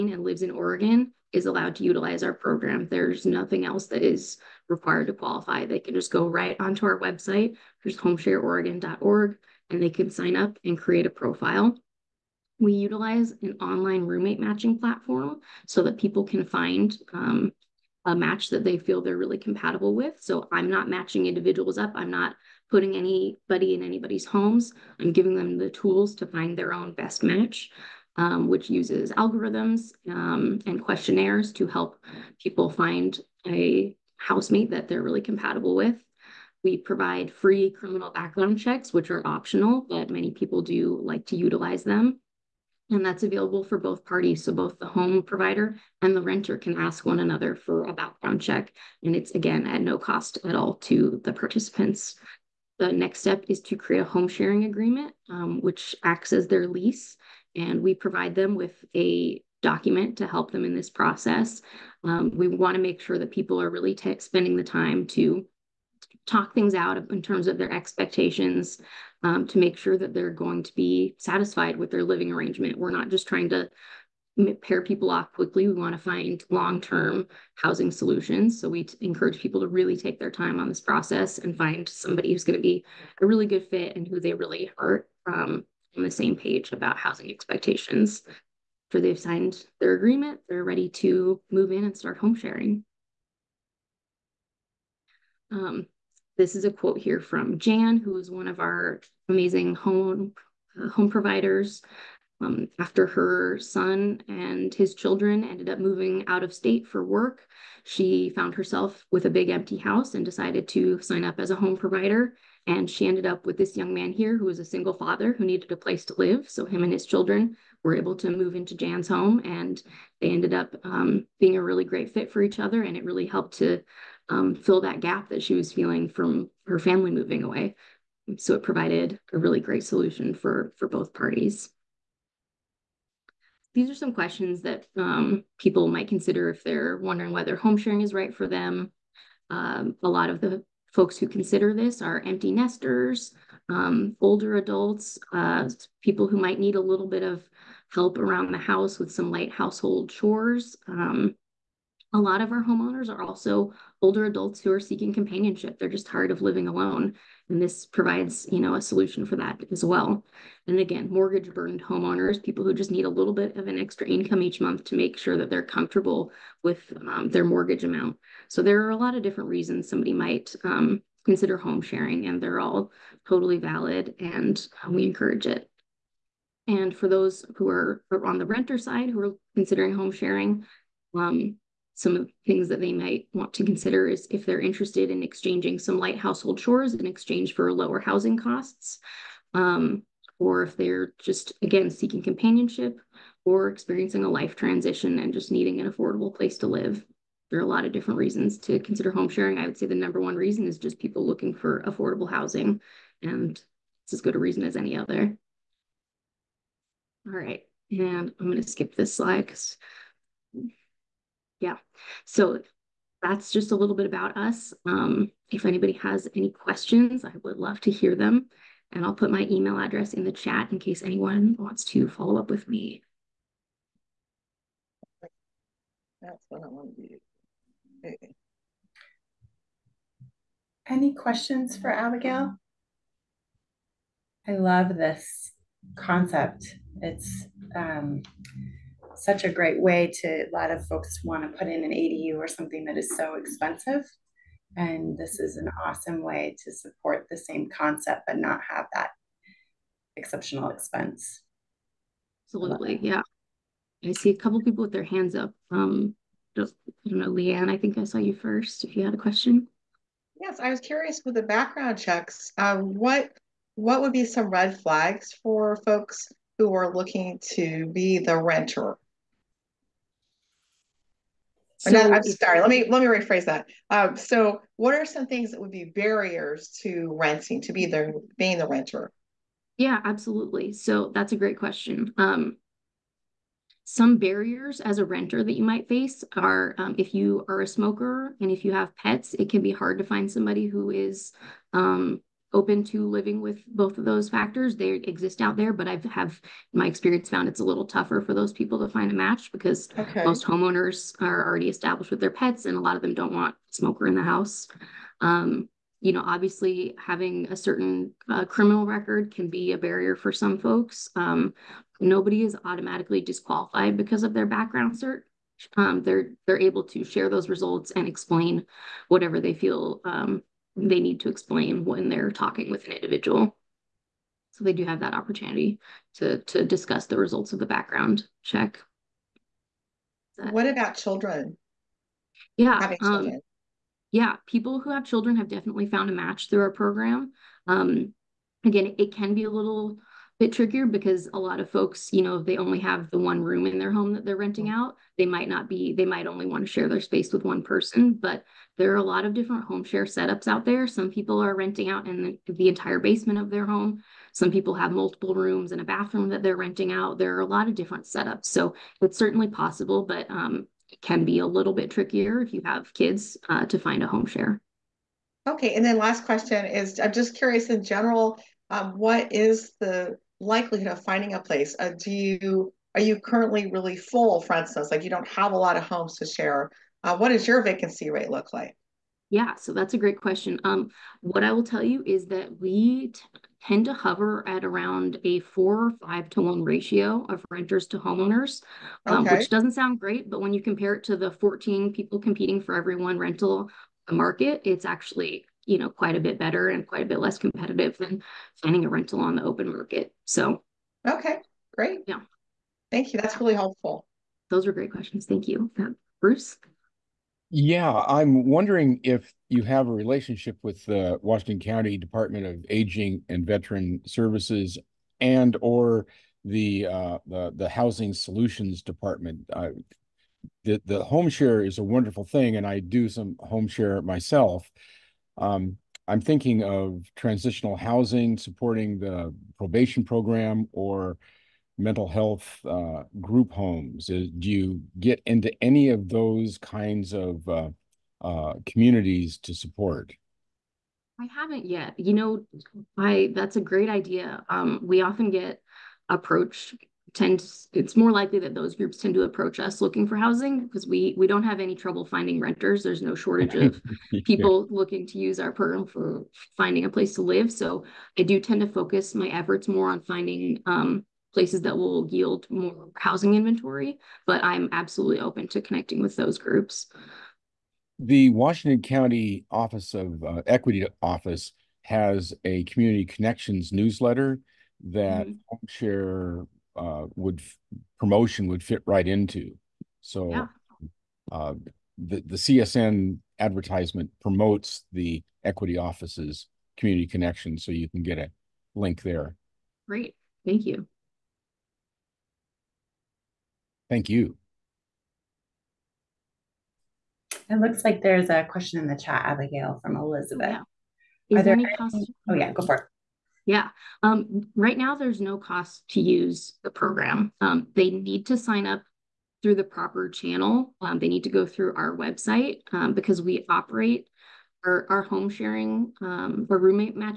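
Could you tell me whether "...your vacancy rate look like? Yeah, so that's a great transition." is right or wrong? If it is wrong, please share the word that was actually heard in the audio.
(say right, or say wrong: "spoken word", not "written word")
wrong: "question", not "transition".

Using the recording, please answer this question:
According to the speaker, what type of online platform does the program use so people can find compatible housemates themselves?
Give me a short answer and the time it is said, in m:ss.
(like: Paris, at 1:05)
online roommate matching platform, at 0:13.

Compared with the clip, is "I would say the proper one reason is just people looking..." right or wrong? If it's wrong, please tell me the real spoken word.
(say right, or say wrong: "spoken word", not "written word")
wrong: "number", not "proper".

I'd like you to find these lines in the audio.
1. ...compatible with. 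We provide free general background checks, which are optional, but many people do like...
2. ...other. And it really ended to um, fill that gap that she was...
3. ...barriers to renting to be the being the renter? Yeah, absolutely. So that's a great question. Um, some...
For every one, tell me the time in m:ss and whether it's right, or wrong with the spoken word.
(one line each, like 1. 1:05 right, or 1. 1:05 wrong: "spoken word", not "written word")
1. 0:35 wrong: "criminal", not "general"
2. 2:02 wrong: "helped", not "ended"
3. 4:35 right.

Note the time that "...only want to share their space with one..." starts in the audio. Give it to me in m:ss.
5:46.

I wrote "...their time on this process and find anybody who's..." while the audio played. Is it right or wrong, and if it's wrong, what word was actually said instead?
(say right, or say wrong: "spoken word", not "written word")
wrong: "somebody", not "anybody".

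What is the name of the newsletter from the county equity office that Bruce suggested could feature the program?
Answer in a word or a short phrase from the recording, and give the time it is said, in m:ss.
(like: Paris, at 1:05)
Community Connections, at 7:52.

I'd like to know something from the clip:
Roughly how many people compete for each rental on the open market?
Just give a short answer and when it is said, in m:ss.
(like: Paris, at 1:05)
14, at 6:31.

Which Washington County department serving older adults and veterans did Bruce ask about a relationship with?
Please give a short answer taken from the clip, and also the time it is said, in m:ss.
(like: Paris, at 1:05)
Department of Aging and Veteran Services, at 6:51.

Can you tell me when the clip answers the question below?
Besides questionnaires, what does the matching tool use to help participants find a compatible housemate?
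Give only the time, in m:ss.
0:29.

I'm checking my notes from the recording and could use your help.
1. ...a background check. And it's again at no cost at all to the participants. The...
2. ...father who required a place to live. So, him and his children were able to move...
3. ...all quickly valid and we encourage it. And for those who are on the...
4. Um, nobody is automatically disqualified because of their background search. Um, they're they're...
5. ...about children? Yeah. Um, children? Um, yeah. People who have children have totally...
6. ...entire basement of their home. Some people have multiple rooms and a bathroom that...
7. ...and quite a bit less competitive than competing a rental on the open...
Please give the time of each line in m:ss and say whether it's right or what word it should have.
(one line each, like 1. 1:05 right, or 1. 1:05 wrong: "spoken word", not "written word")
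1. 0:47 right
2. 1:54 wrong: "needed", not "required"
3. 2:52 wrong: "totally", not "quickly"
4. 5:11 right
5. 5:30 wrong: "definitely", not "totally"
6. 5:52 right
7. 6:36 wrong: "finding", not "competing".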